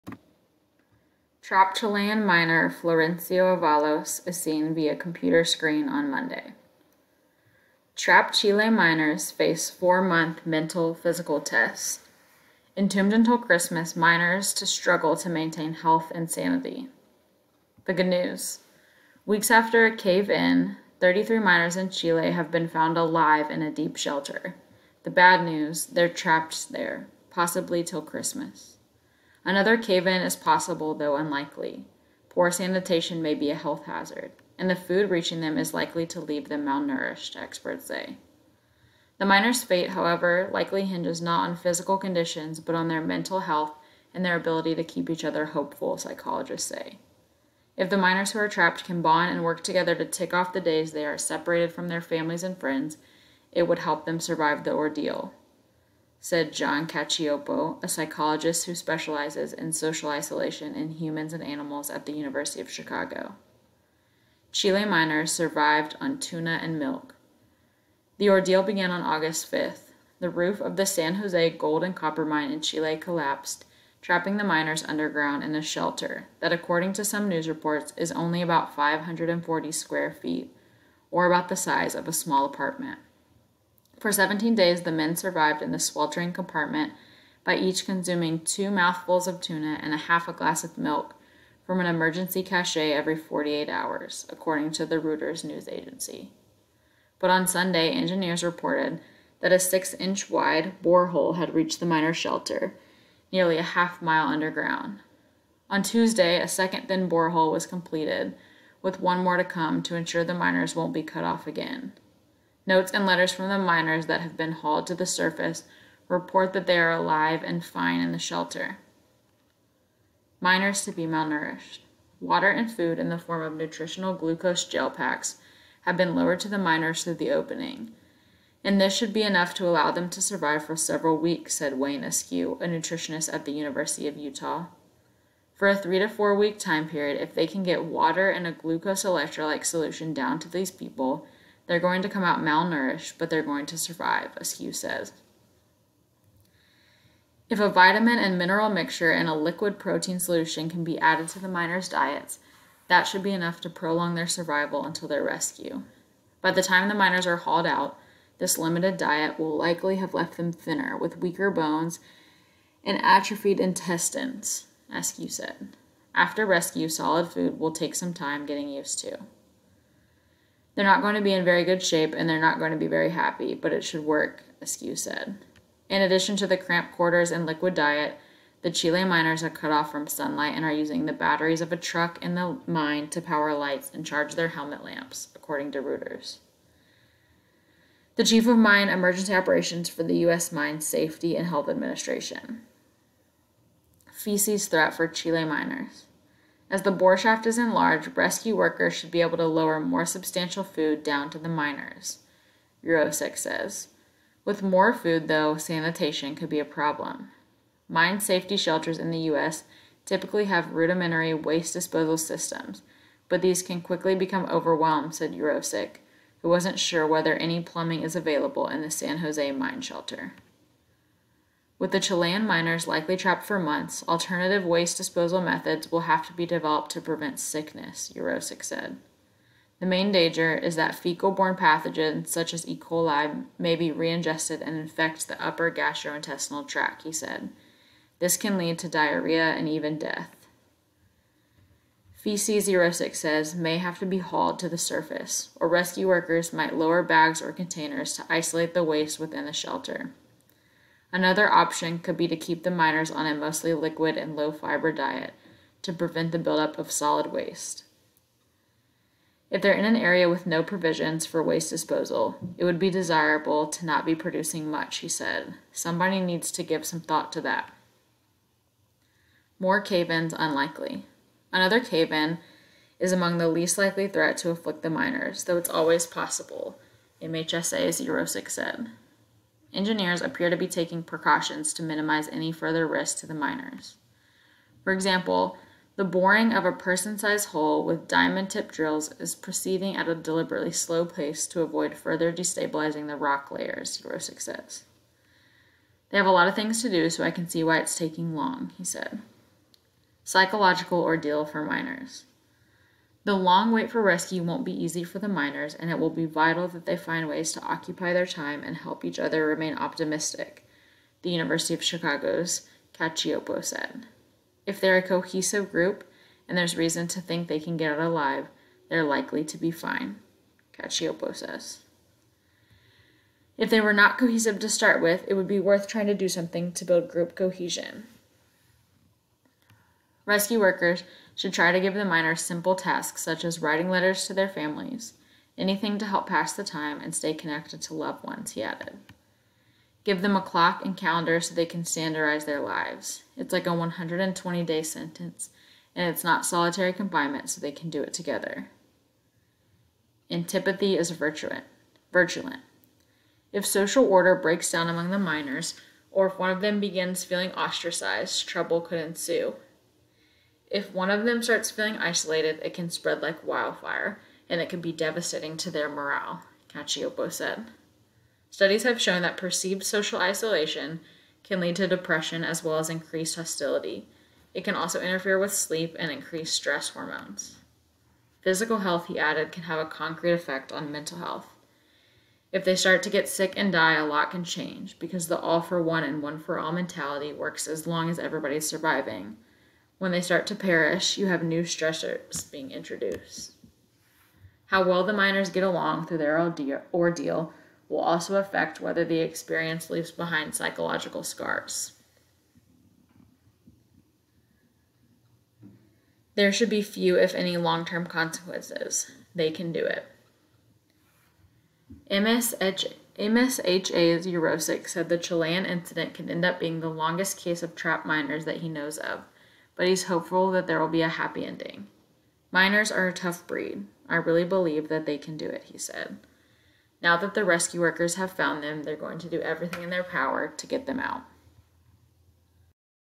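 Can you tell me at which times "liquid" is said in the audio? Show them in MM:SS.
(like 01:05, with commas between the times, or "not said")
02:29, 02:57, 04:13.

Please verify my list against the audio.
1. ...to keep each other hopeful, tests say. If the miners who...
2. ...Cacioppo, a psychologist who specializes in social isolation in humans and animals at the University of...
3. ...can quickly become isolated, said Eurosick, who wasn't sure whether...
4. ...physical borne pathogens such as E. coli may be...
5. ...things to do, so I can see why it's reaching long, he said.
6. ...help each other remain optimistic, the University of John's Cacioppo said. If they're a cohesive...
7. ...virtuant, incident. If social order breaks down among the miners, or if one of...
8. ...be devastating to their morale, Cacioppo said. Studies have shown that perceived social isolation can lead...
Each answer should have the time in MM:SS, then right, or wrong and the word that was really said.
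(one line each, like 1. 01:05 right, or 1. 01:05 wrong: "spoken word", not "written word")
1. 00:44 wrong: "psychologists", not "tests"
2. 00:56 right
3. 03:33 wrong: "overwhelmed", not "isolated"
4. 03:50 wrong: "fecal", not "physical"
5. 04:56 wrong: "taking", not "reaching"
6. 05:08 wrong: "Chicago", not "John"
7. 05:51 wrong: "virulent", not "incident"
8. 06:04 right.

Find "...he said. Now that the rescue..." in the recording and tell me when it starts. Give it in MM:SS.
07:05.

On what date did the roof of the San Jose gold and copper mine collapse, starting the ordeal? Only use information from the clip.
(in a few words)
August 5th.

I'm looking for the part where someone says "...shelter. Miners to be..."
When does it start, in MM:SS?
01:58.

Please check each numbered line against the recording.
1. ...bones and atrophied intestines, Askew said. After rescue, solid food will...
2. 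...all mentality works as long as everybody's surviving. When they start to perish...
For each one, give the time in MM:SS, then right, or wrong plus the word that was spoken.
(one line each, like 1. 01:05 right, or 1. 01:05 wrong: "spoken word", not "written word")
1. 02:41 right
2. 06:26 right.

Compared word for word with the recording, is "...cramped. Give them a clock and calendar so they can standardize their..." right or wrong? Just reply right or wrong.
wrong.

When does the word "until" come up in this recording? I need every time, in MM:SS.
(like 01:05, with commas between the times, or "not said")
00:13, 02:34.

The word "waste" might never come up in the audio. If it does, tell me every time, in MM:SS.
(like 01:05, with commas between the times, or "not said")
03:31, 03:44, 04:08, 04:17, 04:21.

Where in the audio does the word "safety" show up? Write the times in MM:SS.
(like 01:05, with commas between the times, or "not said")
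03:10, 03:28.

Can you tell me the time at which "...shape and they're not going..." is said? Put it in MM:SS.
02:51.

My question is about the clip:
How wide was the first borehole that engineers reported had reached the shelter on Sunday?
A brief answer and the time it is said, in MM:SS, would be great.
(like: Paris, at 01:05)
six inch, at 01:39.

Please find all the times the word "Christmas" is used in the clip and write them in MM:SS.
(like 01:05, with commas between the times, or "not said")
00:13, 00:28.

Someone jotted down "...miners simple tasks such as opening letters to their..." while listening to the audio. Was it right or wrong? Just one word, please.
wrong.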